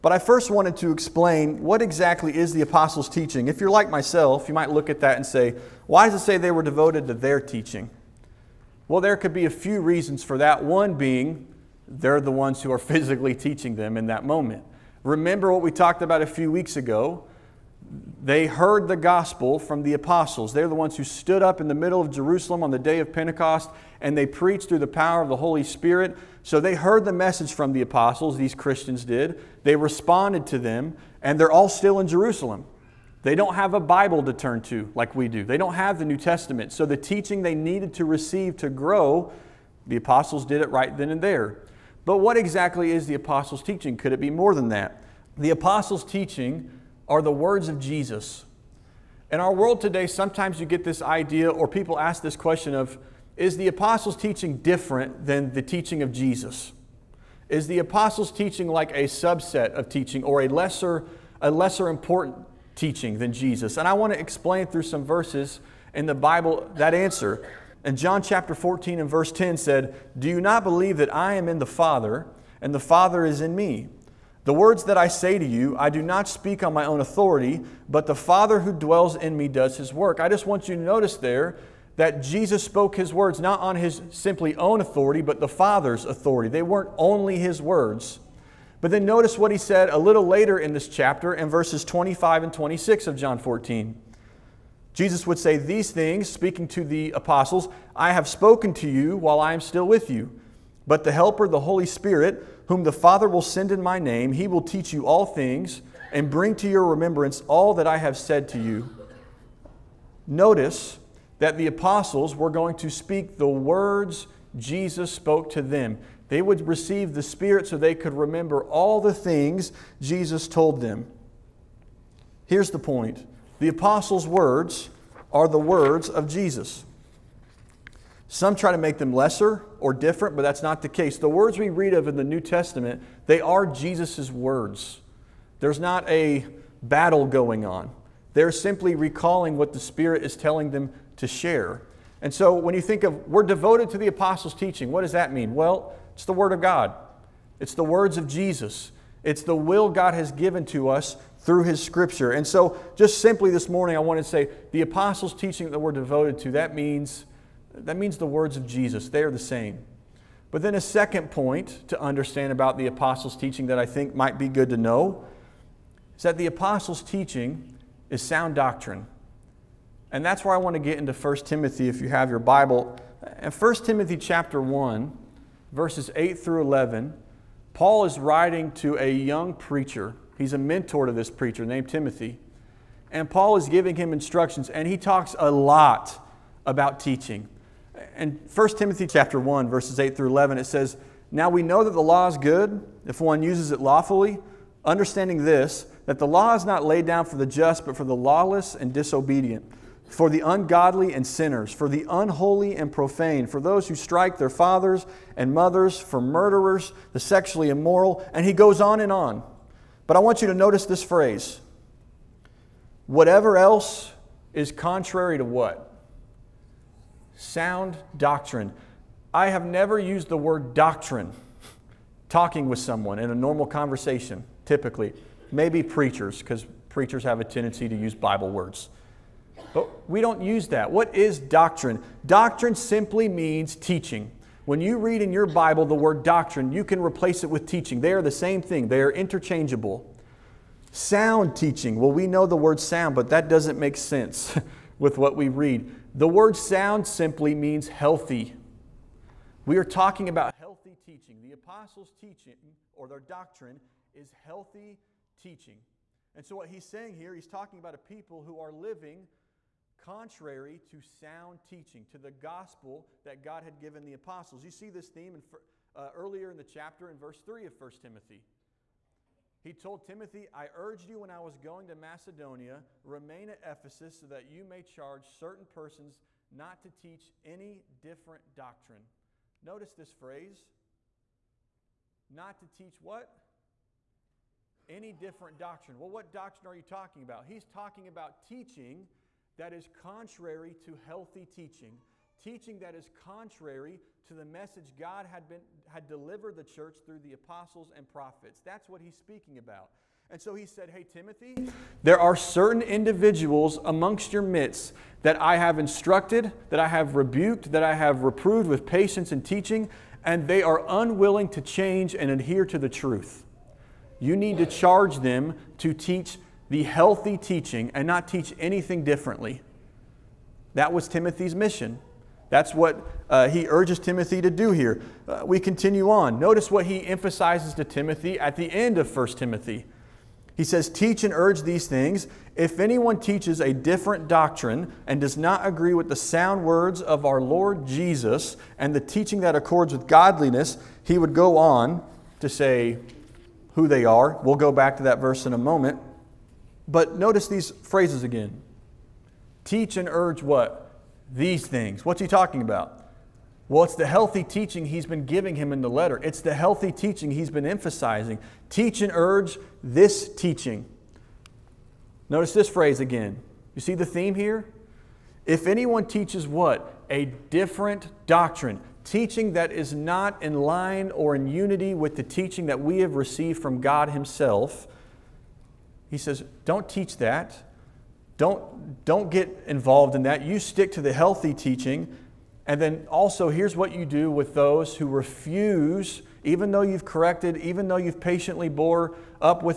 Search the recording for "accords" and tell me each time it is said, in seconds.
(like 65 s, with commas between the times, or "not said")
339 s.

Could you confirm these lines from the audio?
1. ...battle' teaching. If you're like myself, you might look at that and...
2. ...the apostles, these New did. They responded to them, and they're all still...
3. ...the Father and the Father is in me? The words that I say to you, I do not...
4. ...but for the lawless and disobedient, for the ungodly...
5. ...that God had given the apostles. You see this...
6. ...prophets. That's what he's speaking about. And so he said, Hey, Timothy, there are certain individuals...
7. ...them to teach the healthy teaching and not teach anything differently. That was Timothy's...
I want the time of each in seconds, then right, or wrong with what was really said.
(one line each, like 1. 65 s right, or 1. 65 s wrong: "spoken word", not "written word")
1. 2 s wrong: "apostles", not "battle"
2. 27 s wrong: "Christians", not "New"
3. 71 s right
4. 197 s right
5. 263 s right
6. 298 s right
7. 315 s right.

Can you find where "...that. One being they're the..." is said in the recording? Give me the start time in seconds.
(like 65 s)
10 s.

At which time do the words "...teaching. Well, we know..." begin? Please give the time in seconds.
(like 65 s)
241 s.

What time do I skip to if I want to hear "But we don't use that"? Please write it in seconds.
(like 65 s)
229 s.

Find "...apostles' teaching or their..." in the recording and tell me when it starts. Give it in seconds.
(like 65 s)
251 s.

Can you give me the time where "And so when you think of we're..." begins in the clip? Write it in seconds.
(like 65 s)
142 s.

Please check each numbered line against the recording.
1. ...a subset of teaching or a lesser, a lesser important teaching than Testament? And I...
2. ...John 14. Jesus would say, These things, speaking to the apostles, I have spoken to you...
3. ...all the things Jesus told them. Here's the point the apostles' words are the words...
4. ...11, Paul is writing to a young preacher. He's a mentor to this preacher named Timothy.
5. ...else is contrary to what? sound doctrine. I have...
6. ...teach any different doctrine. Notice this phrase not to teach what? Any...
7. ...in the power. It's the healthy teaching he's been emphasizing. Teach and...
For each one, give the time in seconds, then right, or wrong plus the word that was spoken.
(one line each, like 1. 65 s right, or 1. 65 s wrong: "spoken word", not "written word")
1. 58 s wrong: "Jesus", not "Testament"
2. 93 s right
3. 118 s right
4. 176 s right
5. 213 s right
6. 276 s right
7. 355 s wrong: "letter", not "power".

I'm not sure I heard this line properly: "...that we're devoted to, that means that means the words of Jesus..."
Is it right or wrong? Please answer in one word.
right.